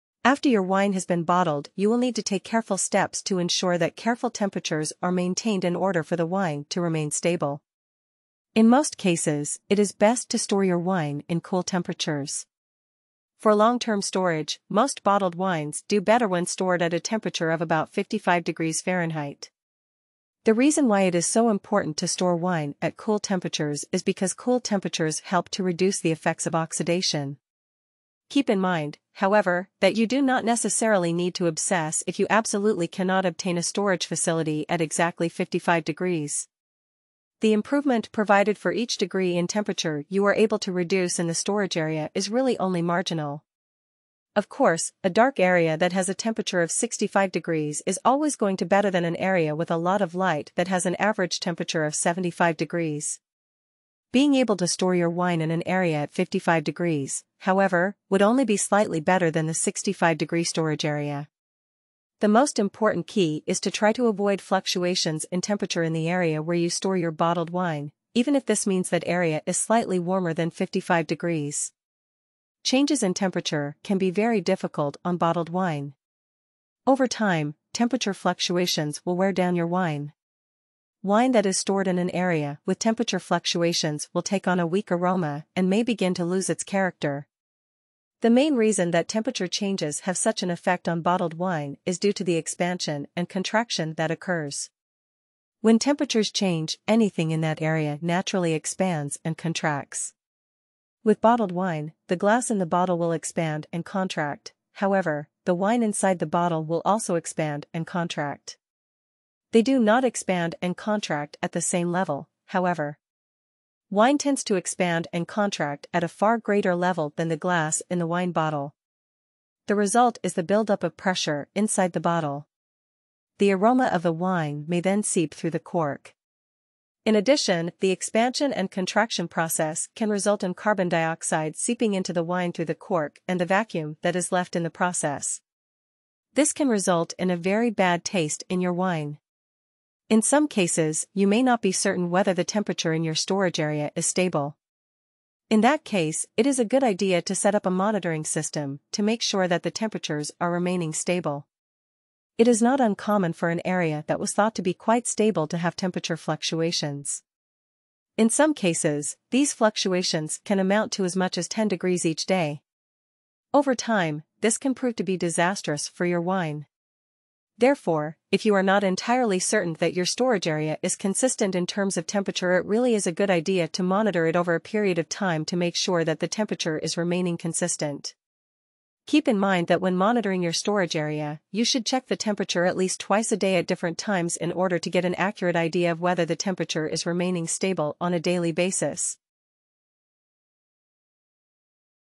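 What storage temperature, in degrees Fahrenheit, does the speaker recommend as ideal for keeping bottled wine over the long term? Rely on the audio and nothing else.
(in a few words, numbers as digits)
55 degrees.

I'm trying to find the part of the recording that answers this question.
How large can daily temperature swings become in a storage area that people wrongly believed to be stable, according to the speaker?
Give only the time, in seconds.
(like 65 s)
161 s.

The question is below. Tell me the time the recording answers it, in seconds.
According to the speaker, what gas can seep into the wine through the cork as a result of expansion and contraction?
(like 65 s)
130 s.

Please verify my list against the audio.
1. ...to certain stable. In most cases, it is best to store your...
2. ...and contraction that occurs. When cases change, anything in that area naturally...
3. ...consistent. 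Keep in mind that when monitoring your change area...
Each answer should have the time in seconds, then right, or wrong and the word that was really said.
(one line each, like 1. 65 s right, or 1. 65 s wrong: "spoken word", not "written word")
1. 6 s wrong: "remain", not "certain"
2. 93 s wrong: "temperatures", not "cases"
3. 177 s wrong: "storage", not "change".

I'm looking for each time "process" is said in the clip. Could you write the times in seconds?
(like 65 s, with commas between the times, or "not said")
129 s, 134 s.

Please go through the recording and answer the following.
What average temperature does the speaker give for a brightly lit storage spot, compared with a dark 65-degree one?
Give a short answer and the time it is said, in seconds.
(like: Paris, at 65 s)
75 degrees, at 51 s.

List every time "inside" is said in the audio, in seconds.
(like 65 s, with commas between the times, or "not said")
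105 s, 121 s.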